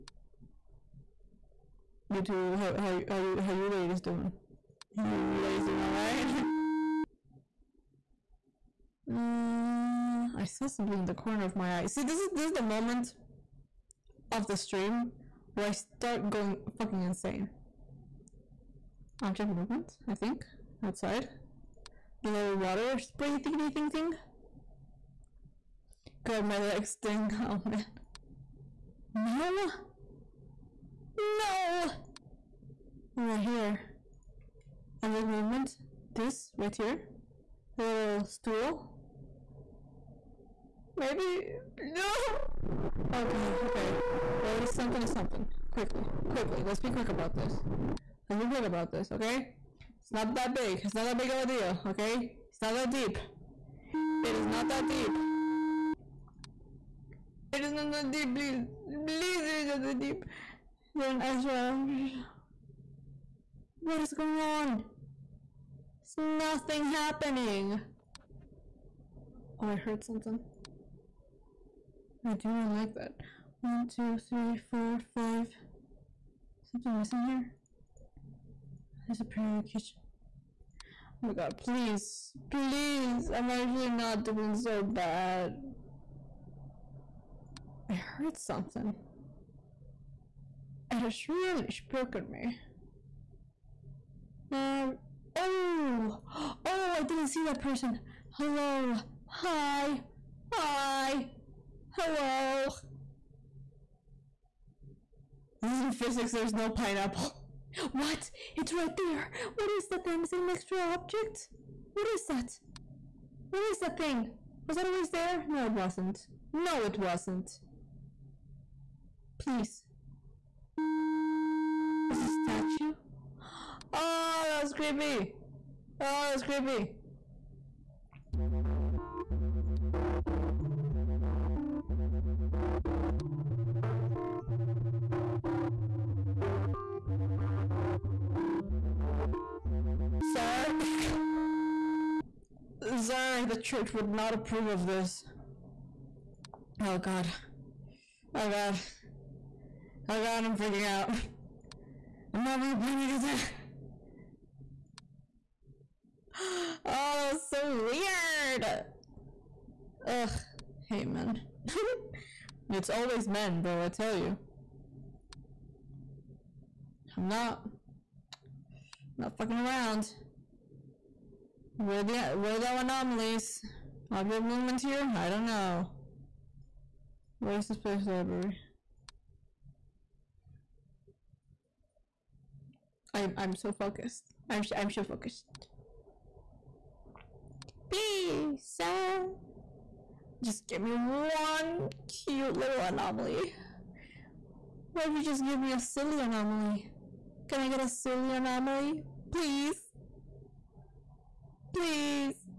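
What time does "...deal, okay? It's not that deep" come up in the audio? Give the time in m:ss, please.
0:51.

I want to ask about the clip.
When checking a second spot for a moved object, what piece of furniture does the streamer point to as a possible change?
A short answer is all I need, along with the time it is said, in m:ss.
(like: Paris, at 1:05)
The little stool, at 0:37.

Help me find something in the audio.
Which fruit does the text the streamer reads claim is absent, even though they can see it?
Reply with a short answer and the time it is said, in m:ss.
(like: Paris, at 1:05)
Pineapple, at 1:46.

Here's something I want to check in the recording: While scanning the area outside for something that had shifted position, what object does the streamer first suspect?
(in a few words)
The little water spray thingy.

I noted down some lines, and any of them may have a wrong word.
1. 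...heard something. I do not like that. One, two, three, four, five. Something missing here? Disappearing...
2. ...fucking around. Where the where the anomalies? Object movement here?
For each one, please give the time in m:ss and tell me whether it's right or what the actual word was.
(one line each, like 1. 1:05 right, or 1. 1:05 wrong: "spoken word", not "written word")
1. 1:09 right
2. 2:49 right.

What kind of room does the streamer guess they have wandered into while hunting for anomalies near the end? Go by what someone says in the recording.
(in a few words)
Library.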